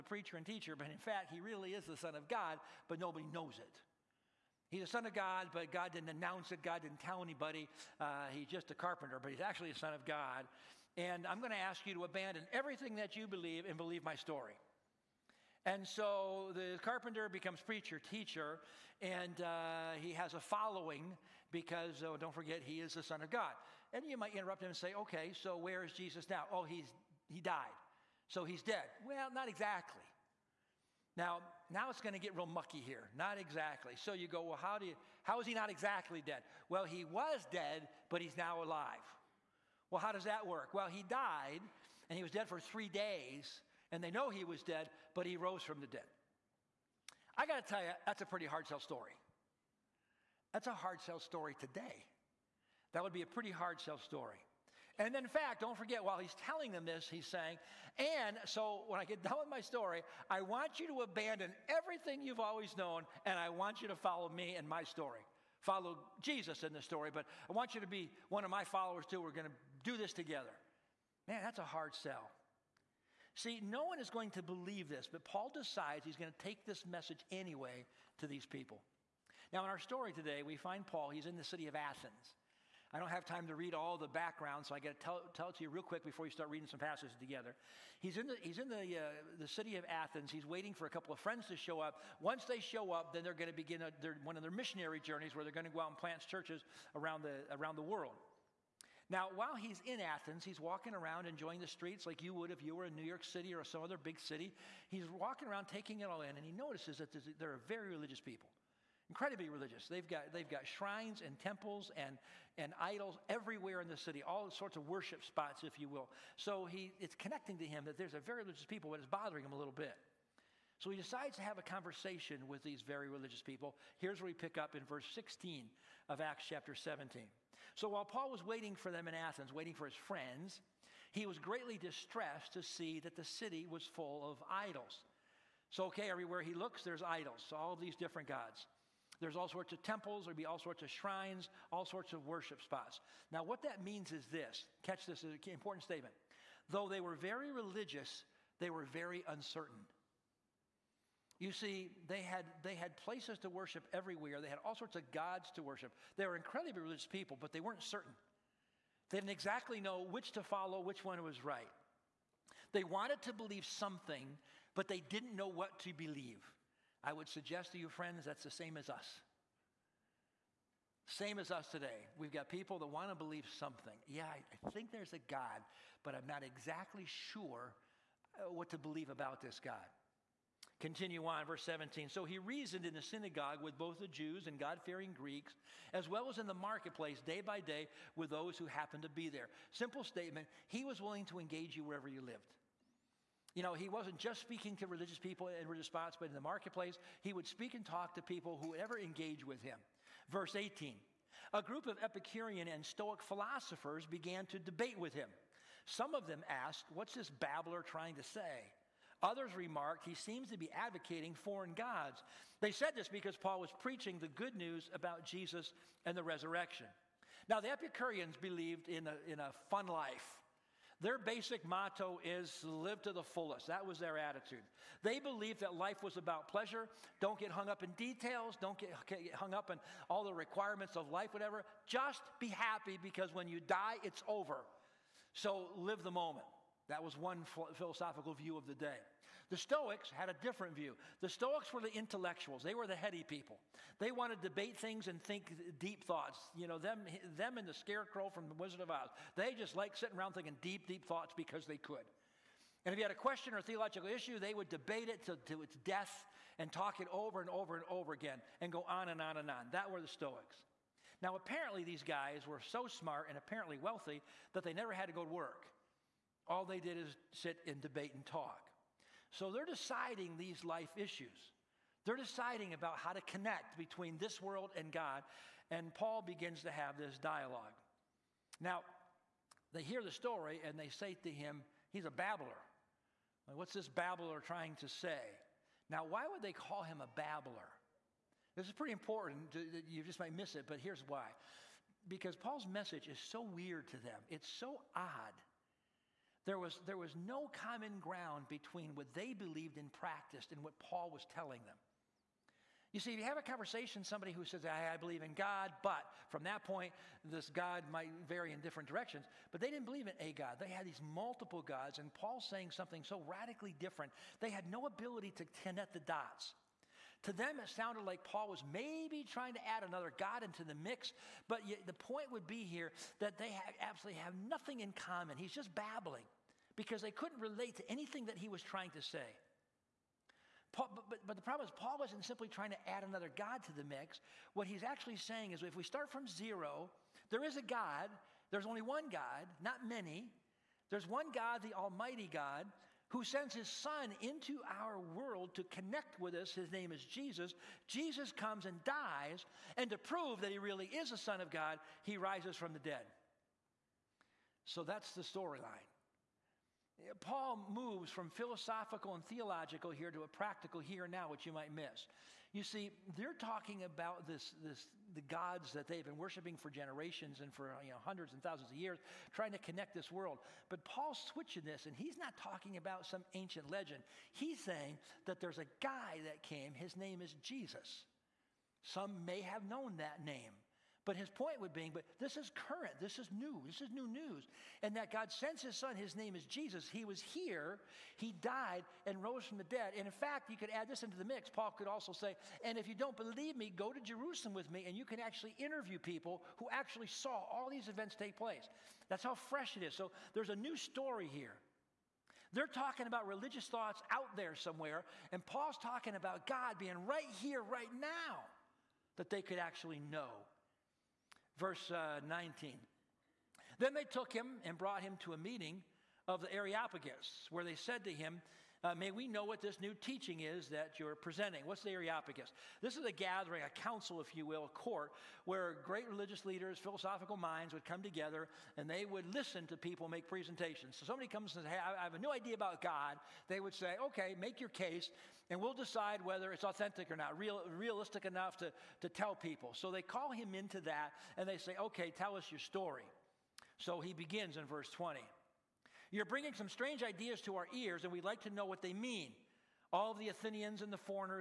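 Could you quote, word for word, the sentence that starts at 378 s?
Some may have known that name.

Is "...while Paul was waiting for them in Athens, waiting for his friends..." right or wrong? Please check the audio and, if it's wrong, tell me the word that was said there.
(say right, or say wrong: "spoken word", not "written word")
right.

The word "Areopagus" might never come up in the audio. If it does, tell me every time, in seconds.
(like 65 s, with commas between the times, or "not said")
416 s, 421 s.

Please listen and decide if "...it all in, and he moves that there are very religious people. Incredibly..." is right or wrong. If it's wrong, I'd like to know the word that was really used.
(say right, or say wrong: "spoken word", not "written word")
wrong: "notices", not "moves".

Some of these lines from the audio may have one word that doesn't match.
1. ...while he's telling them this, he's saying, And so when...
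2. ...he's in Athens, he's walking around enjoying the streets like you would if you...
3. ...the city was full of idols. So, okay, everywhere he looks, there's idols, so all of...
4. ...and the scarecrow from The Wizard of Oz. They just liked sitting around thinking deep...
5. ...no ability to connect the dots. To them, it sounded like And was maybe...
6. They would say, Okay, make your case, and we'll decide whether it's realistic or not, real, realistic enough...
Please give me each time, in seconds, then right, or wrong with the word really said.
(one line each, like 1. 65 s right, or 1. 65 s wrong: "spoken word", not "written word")
1. 56 s right
2. 99 s right
3. 133 s right
4. 247 s right
5. 314 s wrong: "Paul", not "And"
6. 433 s wrong: "authentic", not "realistic".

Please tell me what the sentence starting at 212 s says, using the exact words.
They said this because Paul was preaching the good news about Jesus and the resurrection.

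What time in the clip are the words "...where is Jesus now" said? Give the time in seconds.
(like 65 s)
25 s.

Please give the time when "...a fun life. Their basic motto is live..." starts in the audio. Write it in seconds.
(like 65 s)
219 s.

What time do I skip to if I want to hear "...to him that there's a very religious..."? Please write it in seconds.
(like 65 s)
117 s.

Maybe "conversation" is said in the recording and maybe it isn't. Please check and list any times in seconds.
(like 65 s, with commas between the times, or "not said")
121 s, 303 s.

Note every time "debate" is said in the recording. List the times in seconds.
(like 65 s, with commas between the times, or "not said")
204 s, 244 s, 254 s, 267 s.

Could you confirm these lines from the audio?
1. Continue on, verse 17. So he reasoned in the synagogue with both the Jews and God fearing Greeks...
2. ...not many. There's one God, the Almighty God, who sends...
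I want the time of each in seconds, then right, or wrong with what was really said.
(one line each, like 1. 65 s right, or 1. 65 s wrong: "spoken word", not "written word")
1. 180 s right
2. 339 s right.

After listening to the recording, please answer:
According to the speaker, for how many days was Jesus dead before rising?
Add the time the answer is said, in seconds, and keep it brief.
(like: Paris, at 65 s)
3, at 42 s.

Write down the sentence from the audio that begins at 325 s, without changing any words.
He's just babbling because they couldn't relate to anything that he was trying to say.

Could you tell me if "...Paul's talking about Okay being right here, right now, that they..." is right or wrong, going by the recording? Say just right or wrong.
wrong.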